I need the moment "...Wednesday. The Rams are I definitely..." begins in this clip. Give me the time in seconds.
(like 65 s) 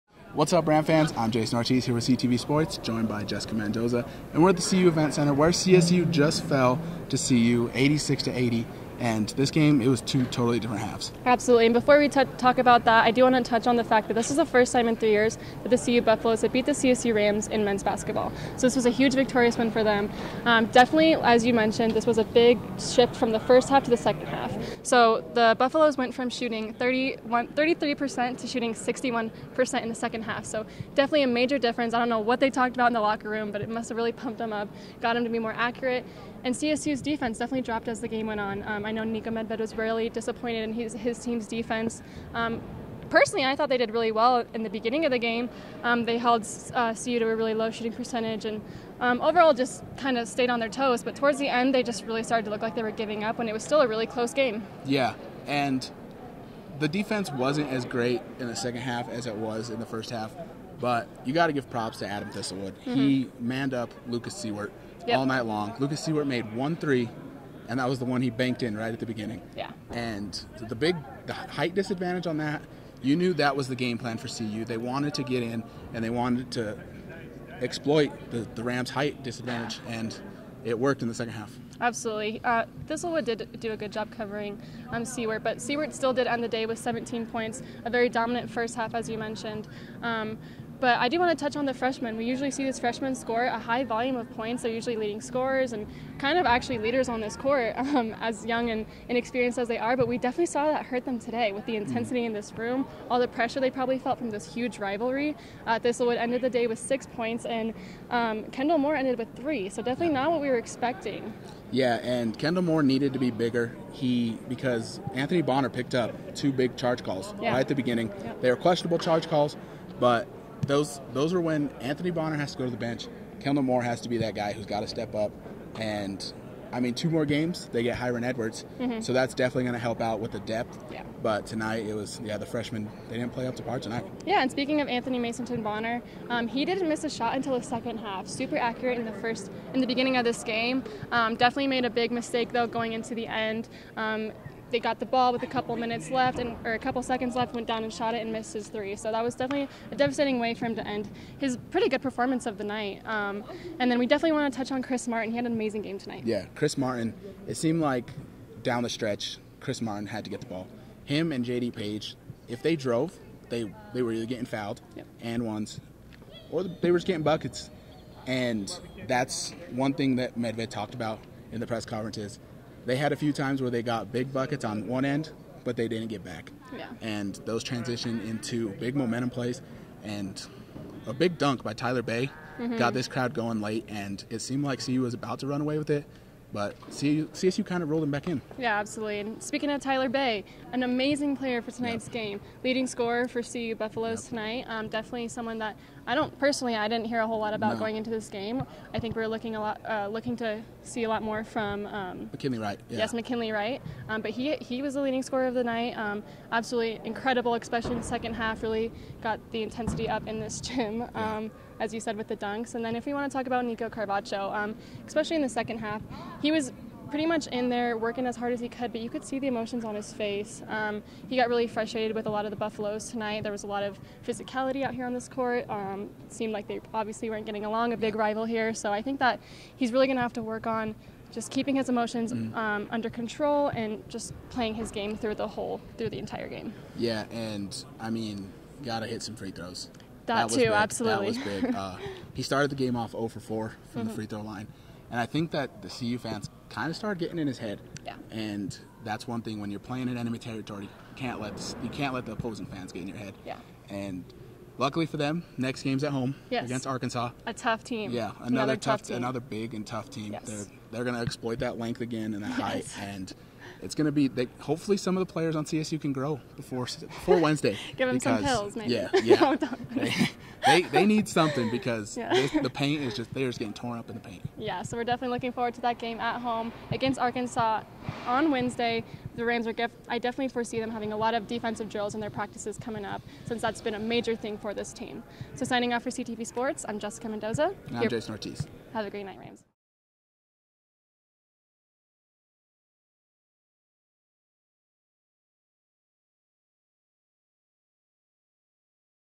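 278 s.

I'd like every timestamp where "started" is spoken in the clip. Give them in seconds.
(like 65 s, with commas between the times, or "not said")
52 s, 242 s, 246 s.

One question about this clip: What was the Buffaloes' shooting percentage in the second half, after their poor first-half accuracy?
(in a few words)
61%.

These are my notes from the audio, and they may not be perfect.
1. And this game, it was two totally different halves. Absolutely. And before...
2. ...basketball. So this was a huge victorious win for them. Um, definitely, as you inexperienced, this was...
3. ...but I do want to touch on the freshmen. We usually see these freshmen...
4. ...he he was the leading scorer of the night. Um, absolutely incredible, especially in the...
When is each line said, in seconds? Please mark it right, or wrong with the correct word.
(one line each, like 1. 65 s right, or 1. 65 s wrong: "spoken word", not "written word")
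1. 8 s right
2. 17 s wrong: "mentioned", not "inexperienced"
3. 90 s right
4. 204 s right.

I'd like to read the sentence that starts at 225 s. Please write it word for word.
Um, seemed like they obviously weren't getting along, a big rival here.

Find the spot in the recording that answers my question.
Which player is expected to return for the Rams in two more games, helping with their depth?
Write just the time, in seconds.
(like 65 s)
127 s.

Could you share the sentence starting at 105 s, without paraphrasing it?
Uh, Thistlewood ended the day with six points, and um, Kendle Moore ended with three.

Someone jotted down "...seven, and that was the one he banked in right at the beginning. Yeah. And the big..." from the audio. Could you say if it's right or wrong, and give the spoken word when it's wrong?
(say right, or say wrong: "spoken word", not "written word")
wrong: "three", not "seven".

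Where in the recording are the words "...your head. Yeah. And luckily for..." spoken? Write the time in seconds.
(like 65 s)
253 s.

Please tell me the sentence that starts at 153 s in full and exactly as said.
Um, and then we definitely want to touch on Kris Martin.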